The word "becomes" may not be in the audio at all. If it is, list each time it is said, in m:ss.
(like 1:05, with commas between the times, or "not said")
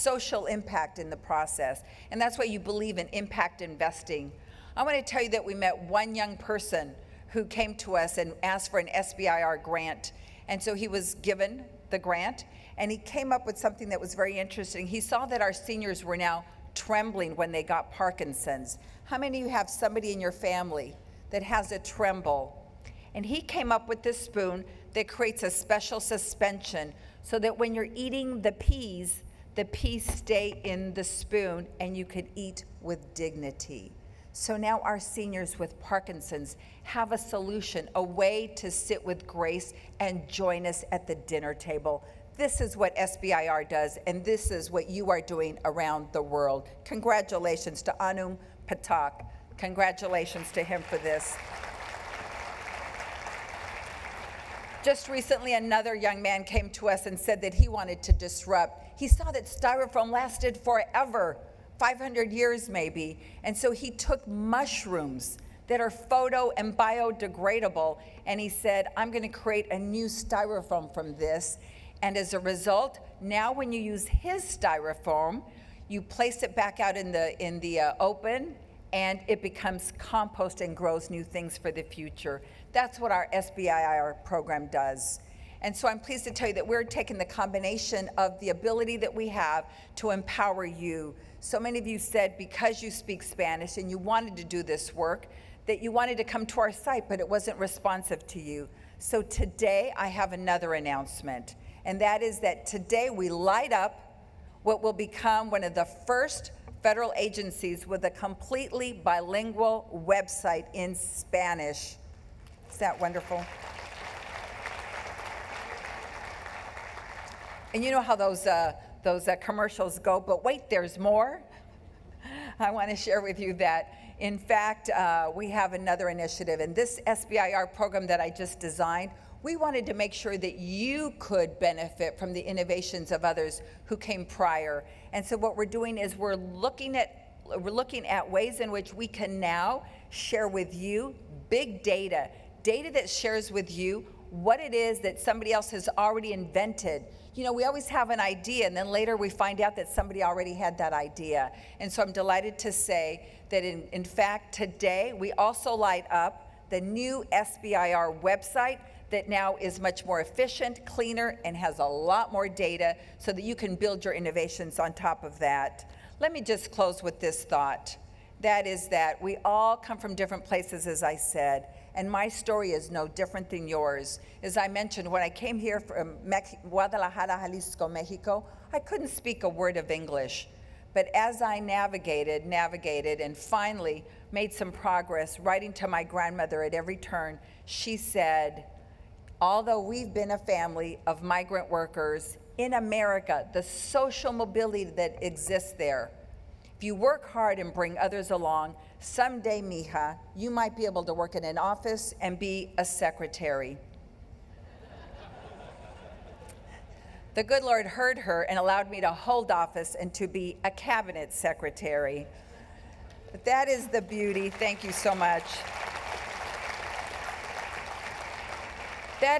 1:19, 1:44.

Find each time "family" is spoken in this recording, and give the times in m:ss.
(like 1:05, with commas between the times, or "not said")
0:20, 3:10.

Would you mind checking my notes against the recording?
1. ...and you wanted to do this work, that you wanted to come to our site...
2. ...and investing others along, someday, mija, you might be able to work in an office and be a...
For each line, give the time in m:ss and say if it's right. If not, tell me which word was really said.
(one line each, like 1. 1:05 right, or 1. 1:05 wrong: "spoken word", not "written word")
1. 1:33 right
2. 3:17 wrong: "bring", not "investing".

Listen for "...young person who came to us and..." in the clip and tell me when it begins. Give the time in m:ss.
0:06.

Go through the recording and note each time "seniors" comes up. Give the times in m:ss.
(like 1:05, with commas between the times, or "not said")
0:15, 0:34.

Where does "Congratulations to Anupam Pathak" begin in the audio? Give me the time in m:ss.
0:46.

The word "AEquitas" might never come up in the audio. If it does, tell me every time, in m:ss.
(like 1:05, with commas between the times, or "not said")
not said.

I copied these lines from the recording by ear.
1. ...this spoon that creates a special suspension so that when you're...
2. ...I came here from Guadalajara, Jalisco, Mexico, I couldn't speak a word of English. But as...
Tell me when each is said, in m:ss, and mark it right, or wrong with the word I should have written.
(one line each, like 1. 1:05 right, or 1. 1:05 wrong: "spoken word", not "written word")
1. 0:24 right
2. 2:55 right.